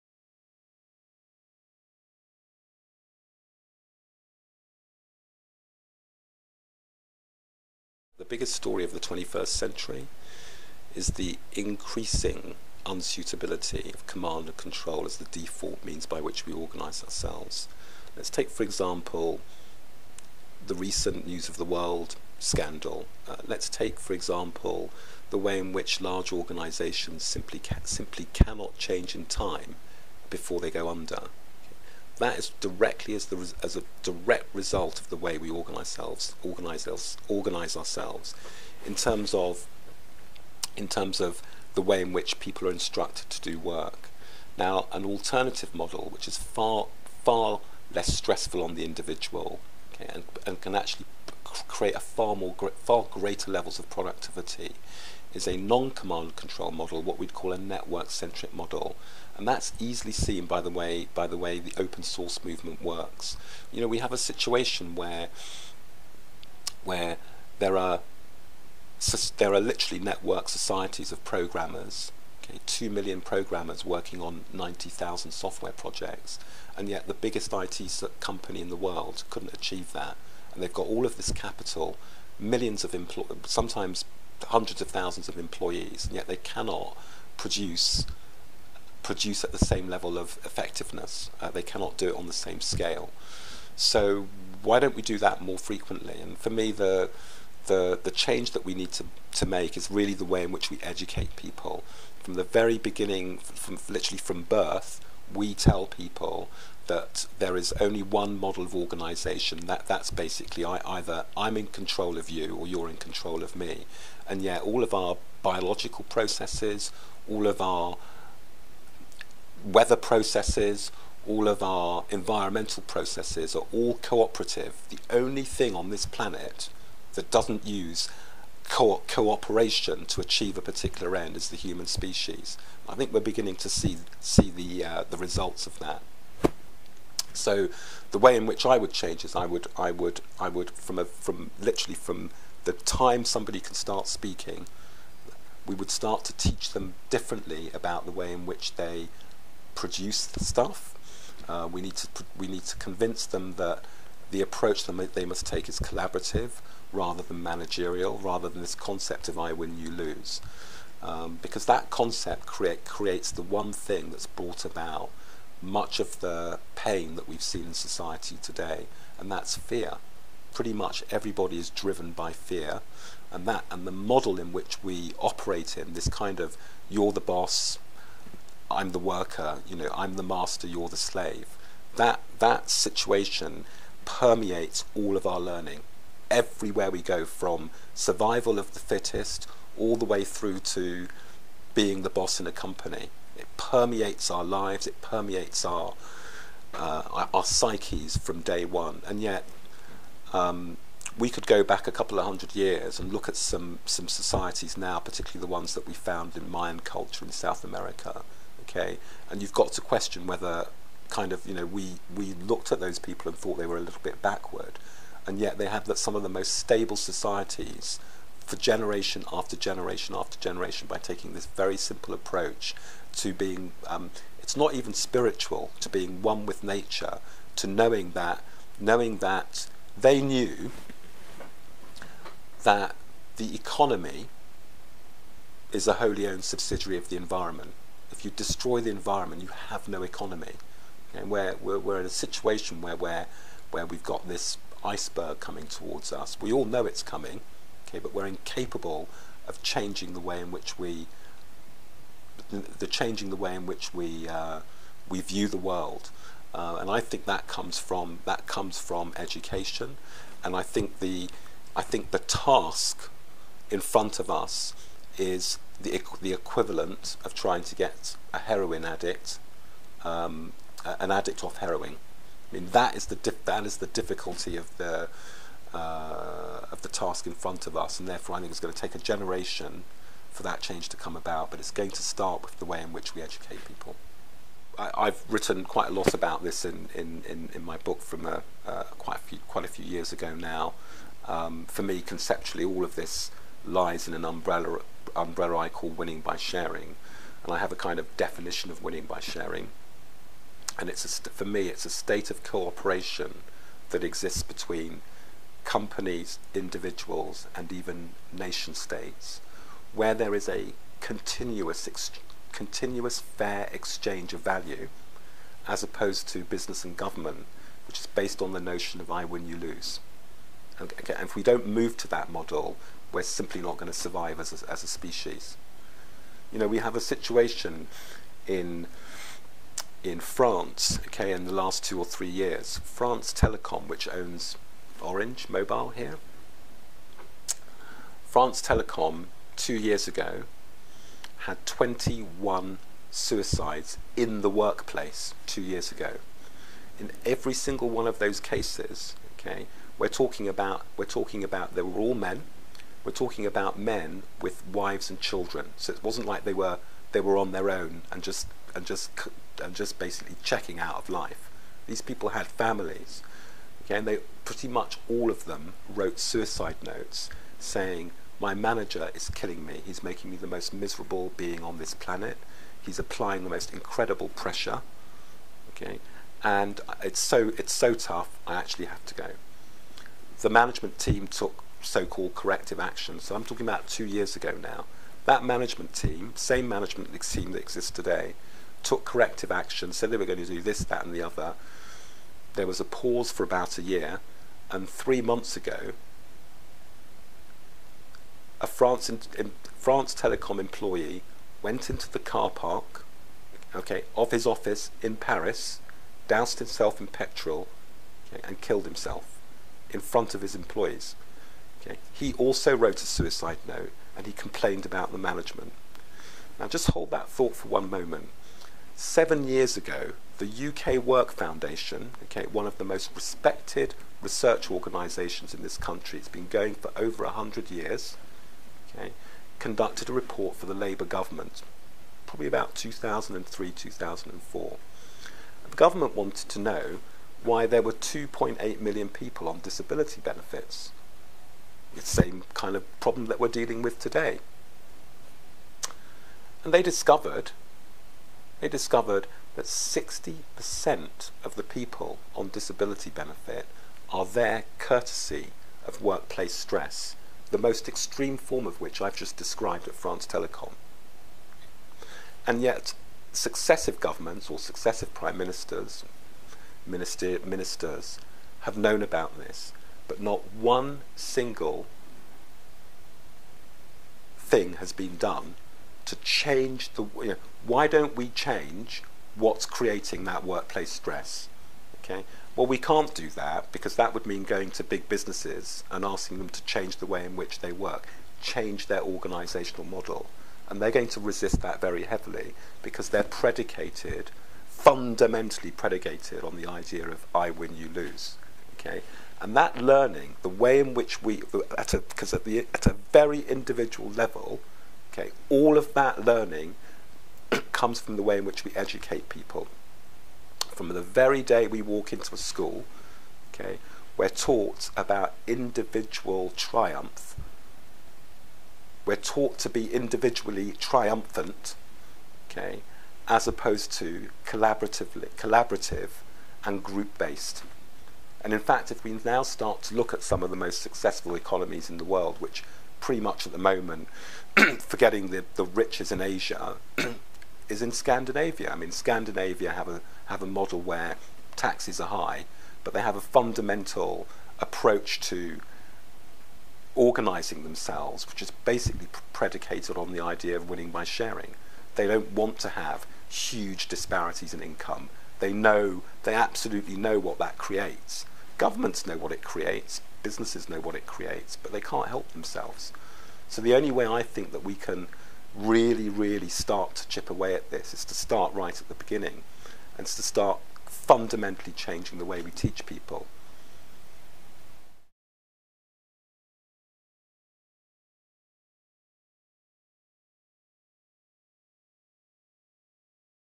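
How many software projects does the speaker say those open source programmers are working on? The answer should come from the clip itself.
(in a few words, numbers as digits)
90,000.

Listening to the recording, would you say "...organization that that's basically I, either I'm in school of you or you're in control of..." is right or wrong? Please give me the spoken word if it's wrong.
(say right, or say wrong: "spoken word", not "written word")
wrong: "control", not "school".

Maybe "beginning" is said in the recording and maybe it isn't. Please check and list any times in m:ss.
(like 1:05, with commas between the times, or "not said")
1:42, 2:13, 9:28.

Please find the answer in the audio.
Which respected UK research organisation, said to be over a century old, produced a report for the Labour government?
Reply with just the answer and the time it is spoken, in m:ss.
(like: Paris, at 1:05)
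UK Work Foundation, at 7:00.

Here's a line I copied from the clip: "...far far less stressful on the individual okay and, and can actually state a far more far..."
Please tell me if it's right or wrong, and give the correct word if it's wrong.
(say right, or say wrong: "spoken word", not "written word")
wrong: "create", not "state".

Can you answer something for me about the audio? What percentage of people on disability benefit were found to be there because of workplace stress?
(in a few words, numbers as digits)
60%.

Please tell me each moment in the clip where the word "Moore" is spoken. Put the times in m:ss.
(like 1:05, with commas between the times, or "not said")
not said.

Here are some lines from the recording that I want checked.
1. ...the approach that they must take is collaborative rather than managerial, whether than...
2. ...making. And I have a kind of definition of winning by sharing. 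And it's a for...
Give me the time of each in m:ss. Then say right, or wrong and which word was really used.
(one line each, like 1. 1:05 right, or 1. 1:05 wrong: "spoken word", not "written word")
1. 2:34 wrong: "rather", not "whether"
2. 4:56 wrong: "sharing", not "making".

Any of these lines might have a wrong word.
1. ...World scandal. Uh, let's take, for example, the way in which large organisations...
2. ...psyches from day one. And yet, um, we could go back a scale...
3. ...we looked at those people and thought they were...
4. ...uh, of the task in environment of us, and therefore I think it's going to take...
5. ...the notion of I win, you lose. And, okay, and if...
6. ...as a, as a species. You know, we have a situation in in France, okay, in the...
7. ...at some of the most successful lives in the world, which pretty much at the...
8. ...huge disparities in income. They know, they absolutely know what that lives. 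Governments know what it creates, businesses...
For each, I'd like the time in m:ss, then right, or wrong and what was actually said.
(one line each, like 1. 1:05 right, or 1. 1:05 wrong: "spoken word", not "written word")
1. 0:21 right
2. 3:17 wrong: "couple", not "scale"
3. 3:32 right
4. 4:35 wrong: "front", not "environment"
5. 5:18 right
6. 5:24 right
7. 8:50 wrong: "economies", not "lives"
8. 9:13 wrong: "creates", not "lives".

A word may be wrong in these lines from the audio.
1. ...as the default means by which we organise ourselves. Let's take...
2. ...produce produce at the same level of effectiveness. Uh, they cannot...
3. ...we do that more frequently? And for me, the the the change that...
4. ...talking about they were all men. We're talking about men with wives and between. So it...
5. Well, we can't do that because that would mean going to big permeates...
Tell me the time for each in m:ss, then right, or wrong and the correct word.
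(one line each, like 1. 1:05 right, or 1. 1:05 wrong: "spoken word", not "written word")
1. 0:15 right
2. 1:27 right
3. 1:34 right
4. 5:51 wrong: "children", not "between"
5. 8:02 wrong: "businesses", not "permeates".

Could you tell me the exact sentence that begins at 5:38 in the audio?
France Telecom two years ago had 21 suicides in the workplace two years ago.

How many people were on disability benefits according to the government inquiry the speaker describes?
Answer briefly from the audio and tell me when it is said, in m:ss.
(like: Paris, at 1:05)
2.8 million, at 7:17.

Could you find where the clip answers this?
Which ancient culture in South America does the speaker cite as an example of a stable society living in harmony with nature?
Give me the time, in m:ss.
3:26.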